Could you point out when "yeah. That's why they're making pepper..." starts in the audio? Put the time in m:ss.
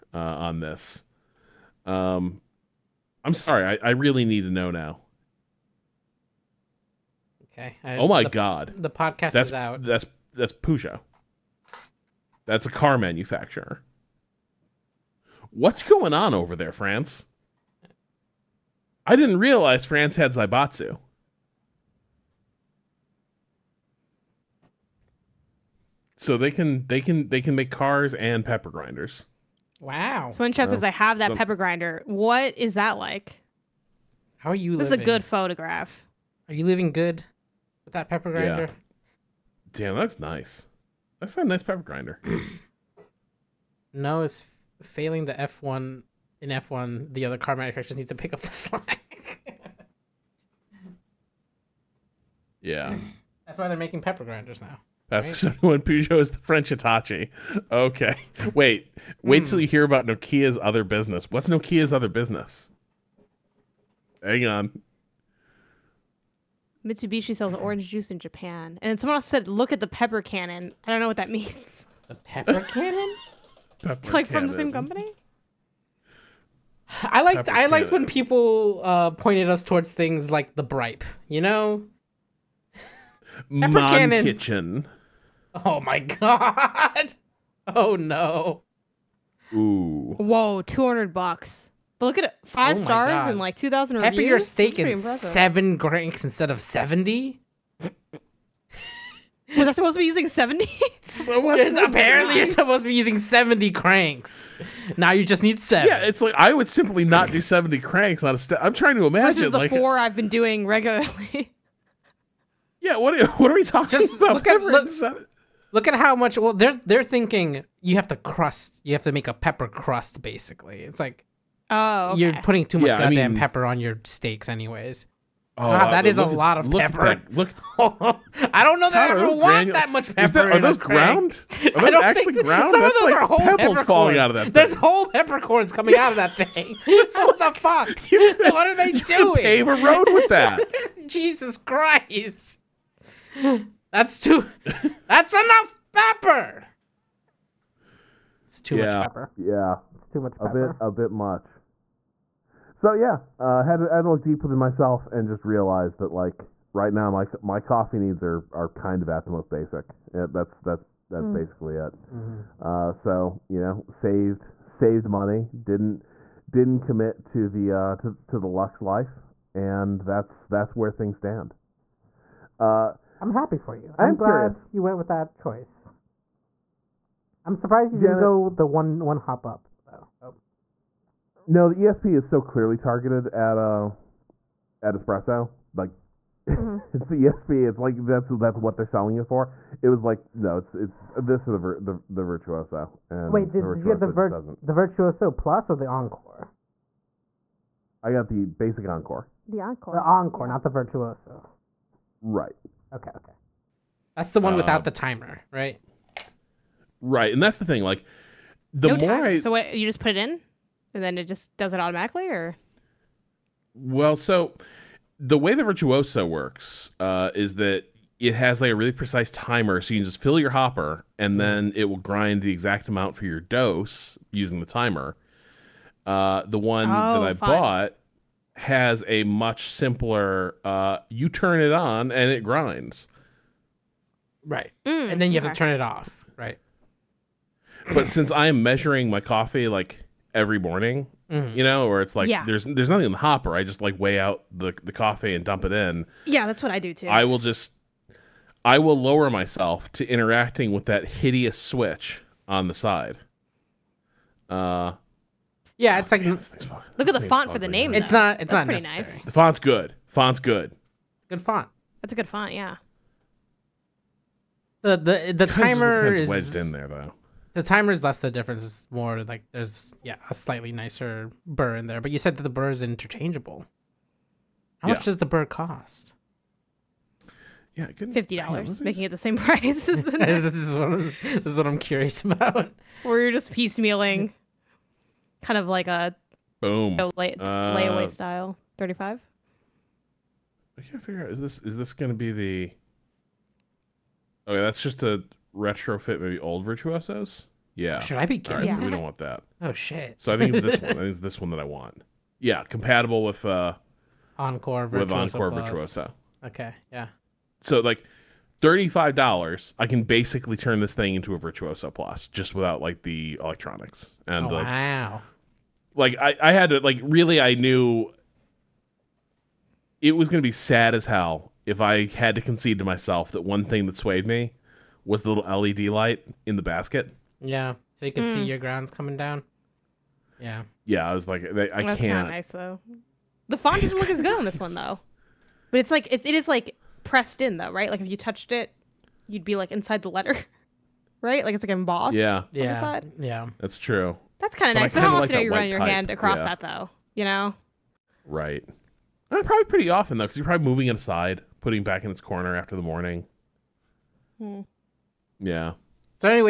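0:52.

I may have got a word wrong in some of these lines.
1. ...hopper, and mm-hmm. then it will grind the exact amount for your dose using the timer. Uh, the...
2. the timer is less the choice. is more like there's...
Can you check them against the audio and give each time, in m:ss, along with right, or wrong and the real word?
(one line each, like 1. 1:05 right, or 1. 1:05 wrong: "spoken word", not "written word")
1. 3:40 right
2. 4:27 wrong: "difference", not "choice".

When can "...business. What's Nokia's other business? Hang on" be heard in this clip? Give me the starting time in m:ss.
1:00.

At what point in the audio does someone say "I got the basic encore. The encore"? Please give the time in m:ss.
3:18.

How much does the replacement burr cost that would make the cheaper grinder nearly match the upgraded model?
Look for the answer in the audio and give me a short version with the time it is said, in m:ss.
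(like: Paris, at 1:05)
$35, at 5:08.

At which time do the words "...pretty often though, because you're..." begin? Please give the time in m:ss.
5:49.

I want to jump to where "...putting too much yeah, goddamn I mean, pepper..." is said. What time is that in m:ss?
2:02.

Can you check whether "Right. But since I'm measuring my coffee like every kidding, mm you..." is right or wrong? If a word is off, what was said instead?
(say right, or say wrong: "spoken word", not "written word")
wrong: "morning", not "kidding".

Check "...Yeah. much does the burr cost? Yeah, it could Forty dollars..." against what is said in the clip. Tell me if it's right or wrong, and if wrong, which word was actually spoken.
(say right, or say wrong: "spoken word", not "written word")
wrong: "Fifty", not "Forty".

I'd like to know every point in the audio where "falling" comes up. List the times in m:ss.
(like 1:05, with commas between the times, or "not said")
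2:13.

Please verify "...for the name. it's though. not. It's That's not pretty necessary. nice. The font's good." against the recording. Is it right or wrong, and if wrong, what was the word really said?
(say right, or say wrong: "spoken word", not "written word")
right.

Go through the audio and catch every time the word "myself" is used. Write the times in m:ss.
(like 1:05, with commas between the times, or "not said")
2:34, 4:09, 5:22.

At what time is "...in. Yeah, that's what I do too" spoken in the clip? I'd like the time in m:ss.
4:05.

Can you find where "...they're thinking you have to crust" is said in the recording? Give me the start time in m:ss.
1:56.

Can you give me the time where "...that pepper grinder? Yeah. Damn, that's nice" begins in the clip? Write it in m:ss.
0:37.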